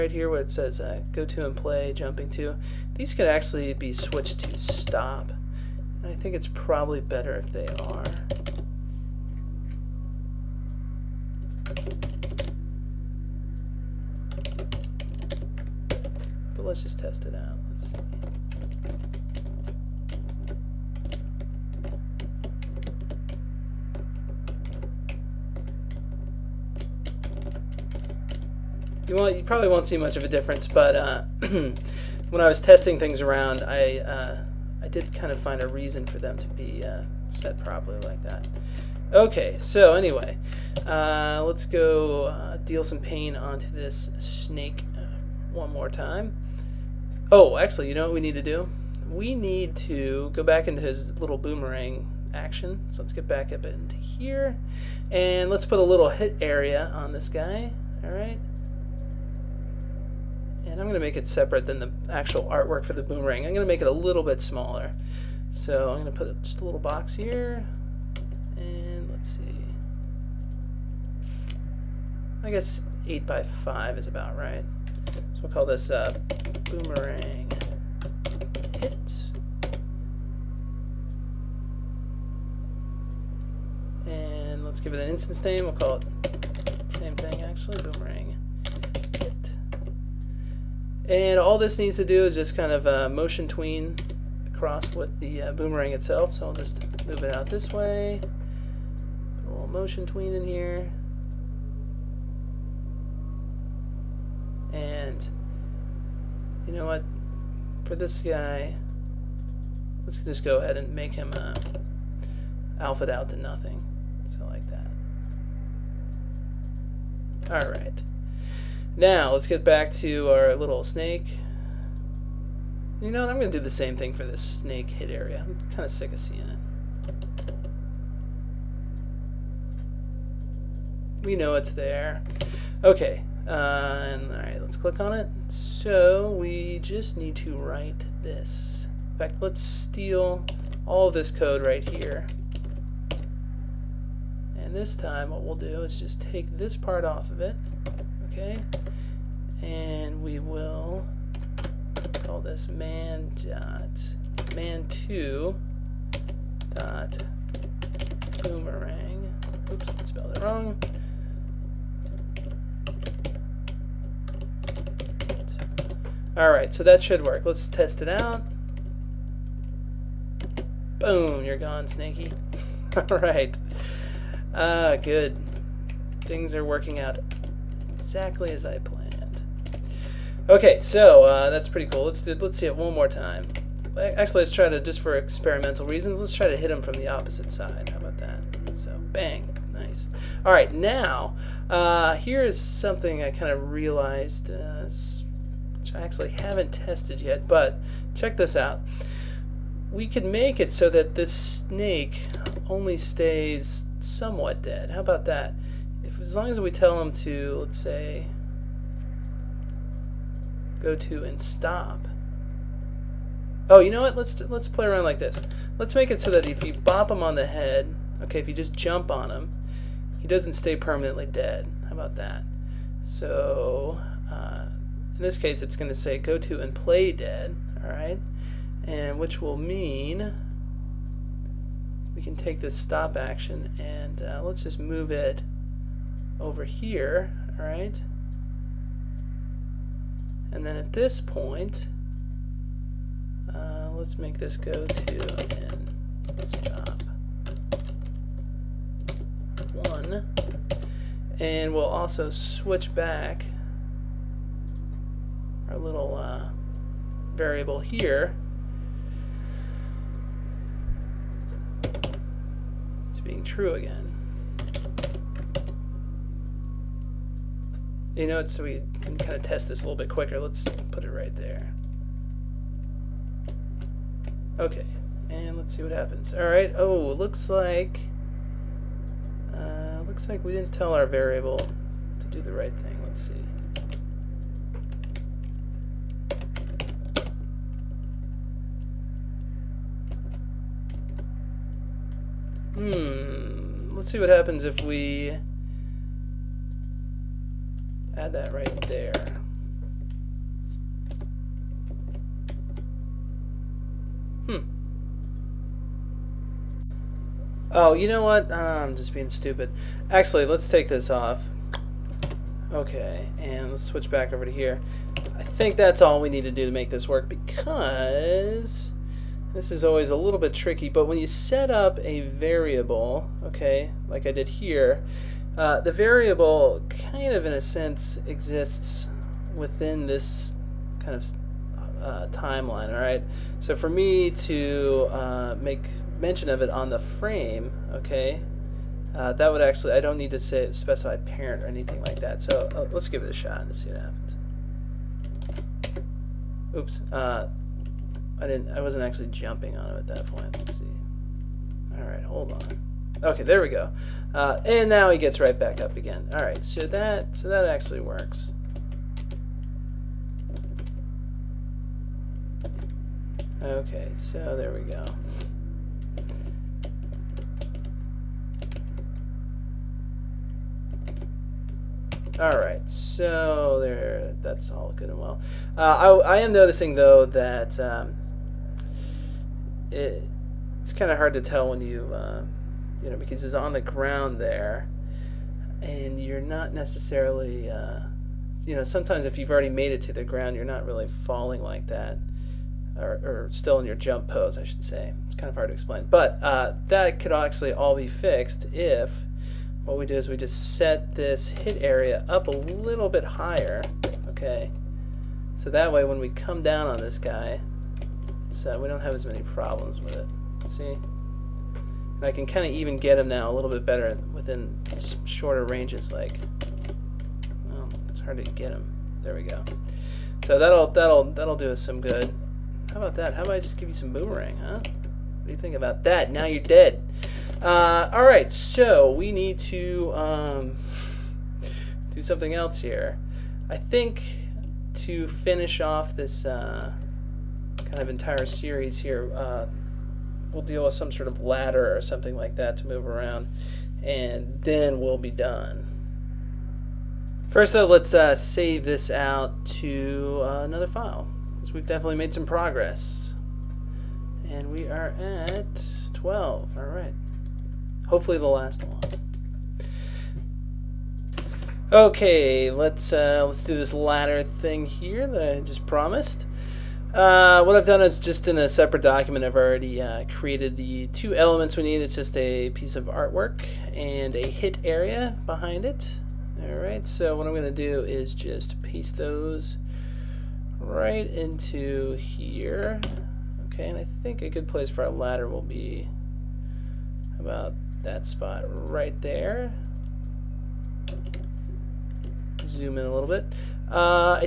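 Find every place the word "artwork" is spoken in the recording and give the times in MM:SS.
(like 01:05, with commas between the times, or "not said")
01:02, 07:53.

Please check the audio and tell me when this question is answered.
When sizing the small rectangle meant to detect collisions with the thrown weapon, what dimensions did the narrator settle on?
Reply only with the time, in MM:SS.
01:13.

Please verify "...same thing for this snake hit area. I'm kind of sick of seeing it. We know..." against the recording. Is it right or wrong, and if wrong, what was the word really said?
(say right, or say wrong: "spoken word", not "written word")
right.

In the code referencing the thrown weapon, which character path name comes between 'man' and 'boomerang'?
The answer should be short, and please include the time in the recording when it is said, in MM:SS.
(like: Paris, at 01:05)
man two, at 02:34.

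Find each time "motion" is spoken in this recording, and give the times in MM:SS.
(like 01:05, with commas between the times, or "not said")
01:33, 01:39.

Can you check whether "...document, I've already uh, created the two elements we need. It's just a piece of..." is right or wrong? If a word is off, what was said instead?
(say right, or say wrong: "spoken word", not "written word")
right.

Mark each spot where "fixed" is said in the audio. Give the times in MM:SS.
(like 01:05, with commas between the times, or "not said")
06:38.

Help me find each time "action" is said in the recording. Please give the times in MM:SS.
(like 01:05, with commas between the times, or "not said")
00:52, 03:53.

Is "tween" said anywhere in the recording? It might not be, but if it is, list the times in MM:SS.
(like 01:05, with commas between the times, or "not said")
01:33, 01:40.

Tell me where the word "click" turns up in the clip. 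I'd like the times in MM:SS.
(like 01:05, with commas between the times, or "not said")
02:14.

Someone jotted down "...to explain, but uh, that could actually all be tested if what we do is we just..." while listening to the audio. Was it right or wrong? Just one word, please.
wrong.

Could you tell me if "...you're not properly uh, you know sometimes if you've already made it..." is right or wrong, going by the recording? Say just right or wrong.
wrong.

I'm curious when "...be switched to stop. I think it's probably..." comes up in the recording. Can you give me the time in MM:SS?
00:03.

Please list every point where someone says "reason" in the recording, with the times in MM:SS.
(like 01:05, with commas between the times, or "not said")
00:35, 03:05.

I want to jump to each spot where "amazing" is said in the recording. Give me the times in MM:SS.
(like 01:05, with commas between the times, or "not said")
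not said.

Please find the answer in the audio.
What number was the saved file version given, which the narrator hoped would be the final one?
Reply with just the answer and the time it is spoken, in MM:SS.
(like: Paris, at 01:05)
12, at 07:36.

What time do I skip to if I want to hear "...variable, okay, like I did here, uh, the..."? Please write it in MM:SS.
05:22.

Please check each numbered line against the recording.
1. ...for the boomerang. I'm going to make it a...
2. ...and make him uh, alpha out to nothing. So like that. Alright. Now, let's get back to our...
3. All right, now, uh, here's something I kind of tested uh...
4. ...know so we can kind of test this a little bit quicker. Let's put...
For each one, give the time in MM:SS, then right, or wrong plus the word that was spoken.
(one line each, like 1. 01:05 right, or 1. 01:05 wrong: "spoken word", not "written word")
1. 01:02 right
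2. 01:50 right
3. 03:10 wrong: "realized", not "tested"
4. 04:28 right.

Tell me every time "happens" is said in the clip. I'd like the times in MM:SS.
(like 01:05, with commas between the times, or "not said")
04:35, 04:54, 05:45.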